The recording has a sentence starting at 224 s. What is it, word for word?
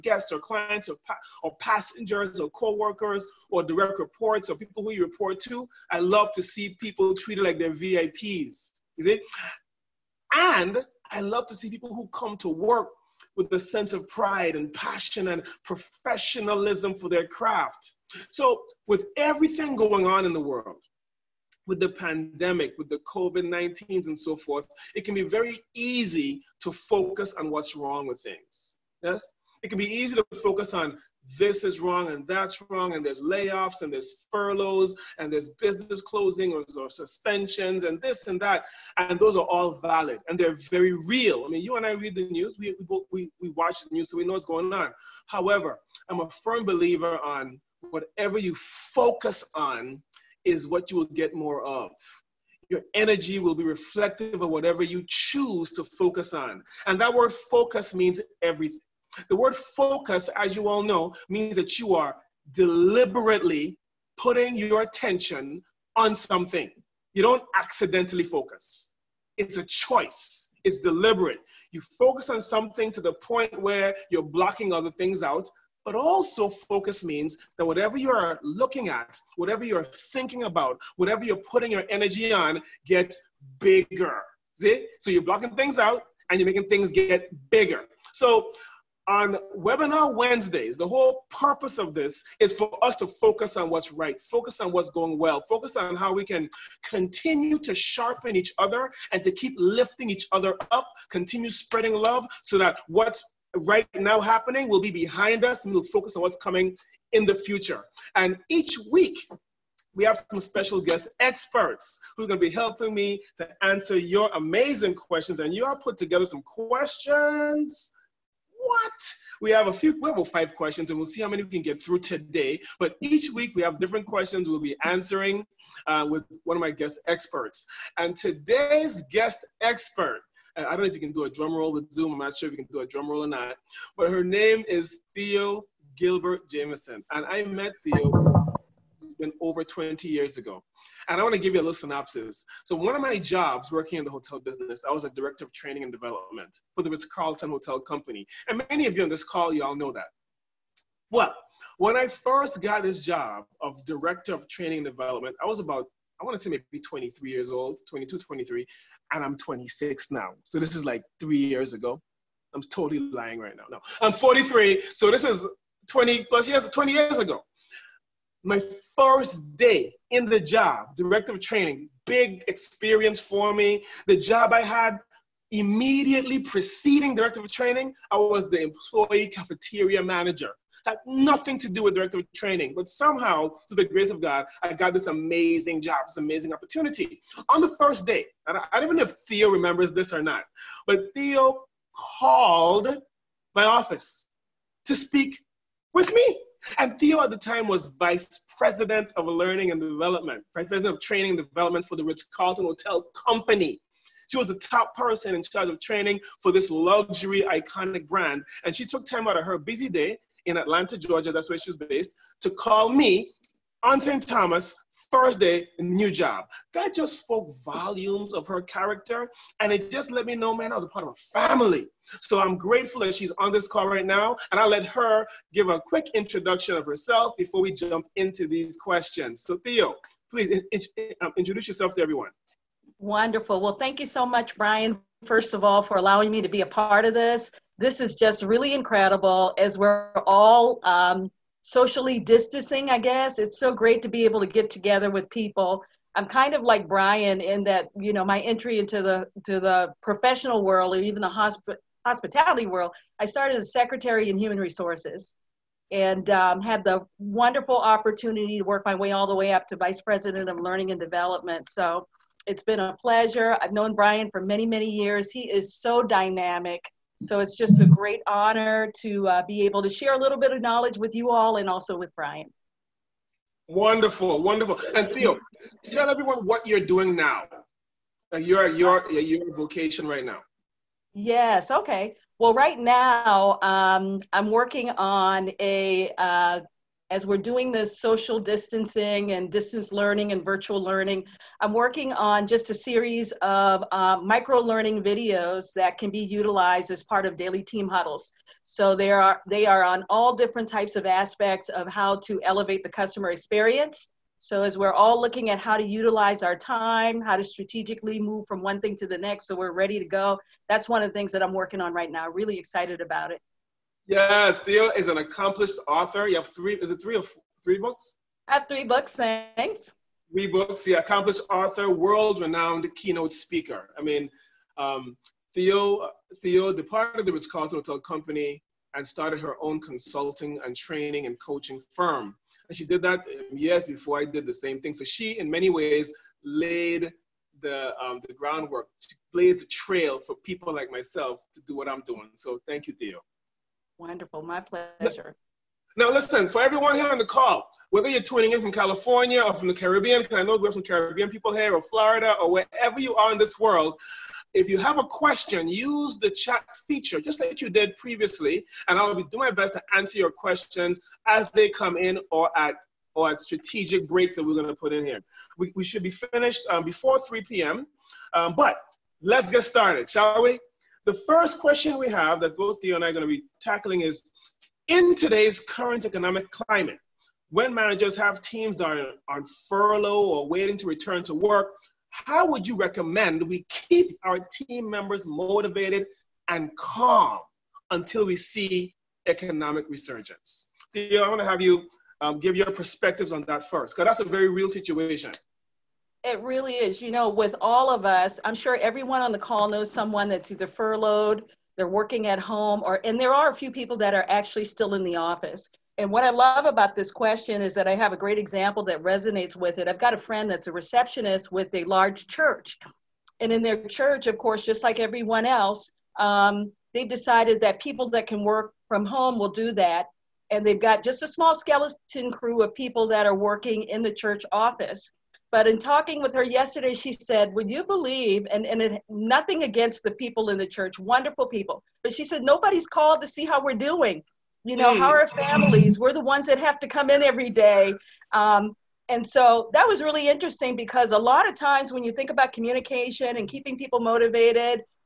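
And I'll let her give a quick introduction of herself before we jump into these questions.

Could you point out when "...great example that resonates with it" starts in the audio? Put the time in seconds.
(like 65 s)
408 s.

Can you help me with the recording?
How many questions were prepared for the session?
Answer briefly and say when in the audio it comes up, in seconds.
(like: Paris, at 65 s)
5, at 120 s.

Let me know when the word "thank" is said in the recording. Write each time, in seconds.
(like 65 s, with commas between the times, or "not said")
233 s, 319 s, 342 s.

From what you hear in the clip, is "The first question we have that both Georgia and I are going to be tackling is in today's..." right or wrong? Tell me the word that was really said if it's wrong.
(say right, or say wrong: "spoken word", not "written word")
wrong: "Theo", not "Georgia".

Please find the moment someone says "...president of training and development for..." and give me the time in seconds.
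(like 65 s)
200 s.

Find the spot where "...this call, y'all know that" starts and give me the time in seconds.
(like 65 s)
149 s.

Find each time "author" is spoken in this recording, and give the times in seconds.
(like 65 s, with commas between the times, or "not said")
315 s, 321 s.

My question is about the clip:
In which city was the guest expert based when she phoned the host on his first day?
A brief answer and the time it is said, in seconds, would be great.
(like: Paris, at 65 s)
Atlanta, at 210 s.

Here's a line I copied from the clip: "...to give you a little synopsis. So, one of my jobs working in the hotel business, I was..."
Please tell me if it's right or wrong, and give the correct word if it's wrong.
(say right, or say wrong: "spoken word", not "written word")
right.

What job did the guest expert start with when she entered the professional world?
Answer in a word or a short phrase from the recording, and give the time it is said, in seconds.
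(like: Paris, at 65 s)
Secretary in human resources, at 253 s.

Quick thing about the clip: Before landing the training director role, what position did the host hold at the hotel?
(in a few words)
Employee cafeteria manager.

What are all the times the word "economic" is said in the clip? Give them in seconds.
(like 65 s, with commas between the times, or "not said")
376 s, 389 s.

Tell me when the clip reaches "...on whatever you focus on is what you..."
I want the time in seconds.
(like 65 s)
47 s.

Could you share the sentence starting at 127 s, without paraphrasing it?
And today's guest expert, uh, I don't know if you can do a drum roll with Zoom.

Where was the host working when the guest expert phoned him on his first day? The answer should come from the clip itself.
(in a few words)
St. Thomas.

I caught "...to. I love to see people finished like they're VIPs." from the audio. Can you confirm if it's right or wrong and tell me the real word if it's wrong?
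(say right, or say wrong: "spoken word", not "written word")
wrong: "treated", not "finished".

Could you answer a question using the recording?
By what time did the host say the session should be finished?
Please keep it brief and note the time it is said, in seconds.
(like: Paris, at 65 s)
3 p.m., at 367 s.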